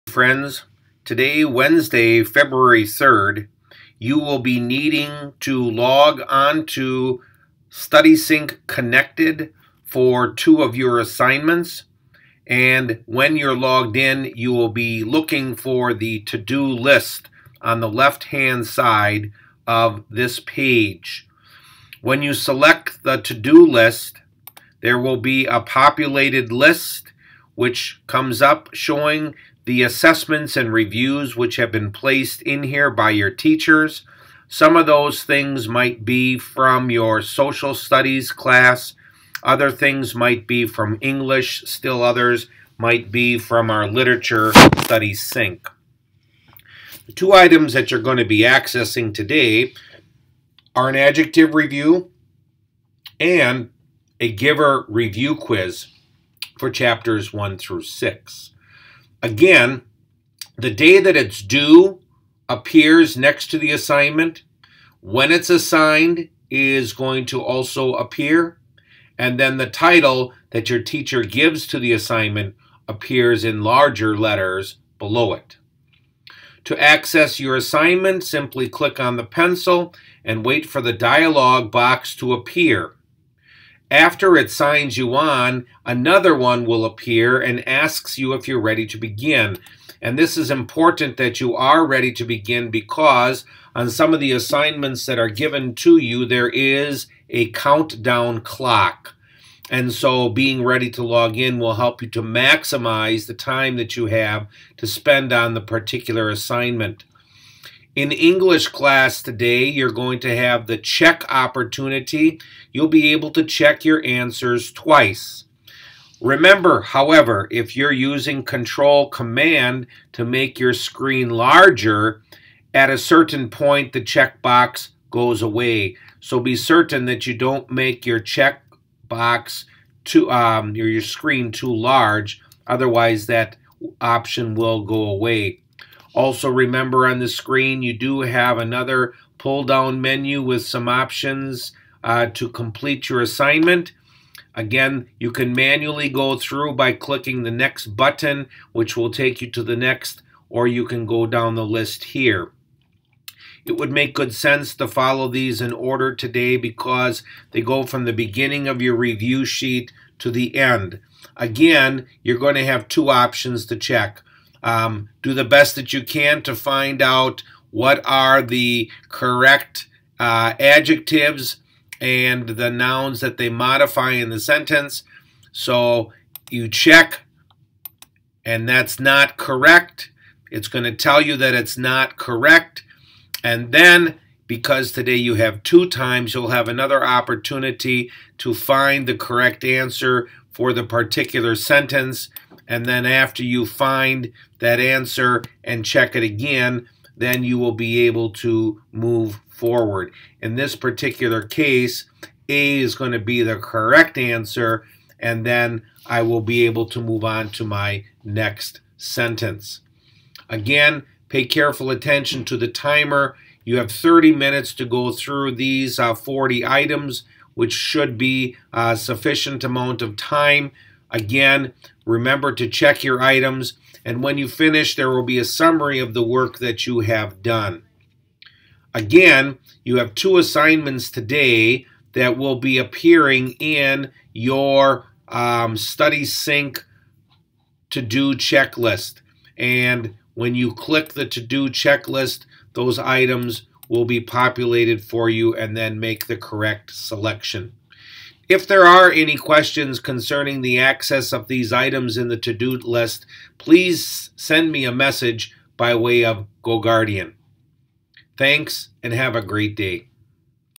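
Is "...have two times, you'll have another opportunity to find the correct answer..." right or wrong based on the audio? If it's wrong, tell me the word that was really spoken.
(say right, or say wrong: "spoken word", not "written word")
right.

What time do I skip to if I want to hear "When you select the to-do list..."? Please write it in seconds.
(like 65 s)
22 s.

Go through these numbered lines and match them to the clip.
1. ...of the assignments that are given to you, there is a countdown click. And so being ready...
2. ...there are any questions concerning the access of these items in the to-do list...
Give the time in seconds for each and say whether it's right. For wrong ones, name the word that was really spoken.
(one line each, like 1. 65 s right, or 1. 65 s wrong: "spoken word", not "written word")
1. 94 s wrong: "clock", not "click"
2. 248 s right.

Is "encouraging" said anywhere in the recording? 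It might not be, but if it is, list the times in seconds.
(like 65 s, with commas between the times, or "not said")
not said.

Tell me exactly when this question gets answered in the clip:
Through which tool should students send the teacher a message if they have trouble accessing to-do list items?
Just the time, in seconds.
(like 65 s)
256 s.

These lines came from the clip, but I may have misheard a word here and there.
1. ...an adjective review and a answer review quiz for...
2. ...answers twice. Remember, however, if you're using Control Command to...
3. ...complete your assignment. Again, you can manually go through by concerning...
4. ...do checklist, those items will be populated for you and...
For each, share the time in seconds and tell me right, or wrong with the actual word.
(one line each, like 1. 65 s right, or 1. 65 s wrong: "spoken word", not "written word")
1. 50 s wrong: "giver", not "answer"
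2. 114 s right
3. 142 s wrong: "clicking", not "concerning"
4. 241 s right.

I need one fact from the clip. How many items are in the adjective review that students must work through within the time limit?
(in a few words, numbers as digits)
40.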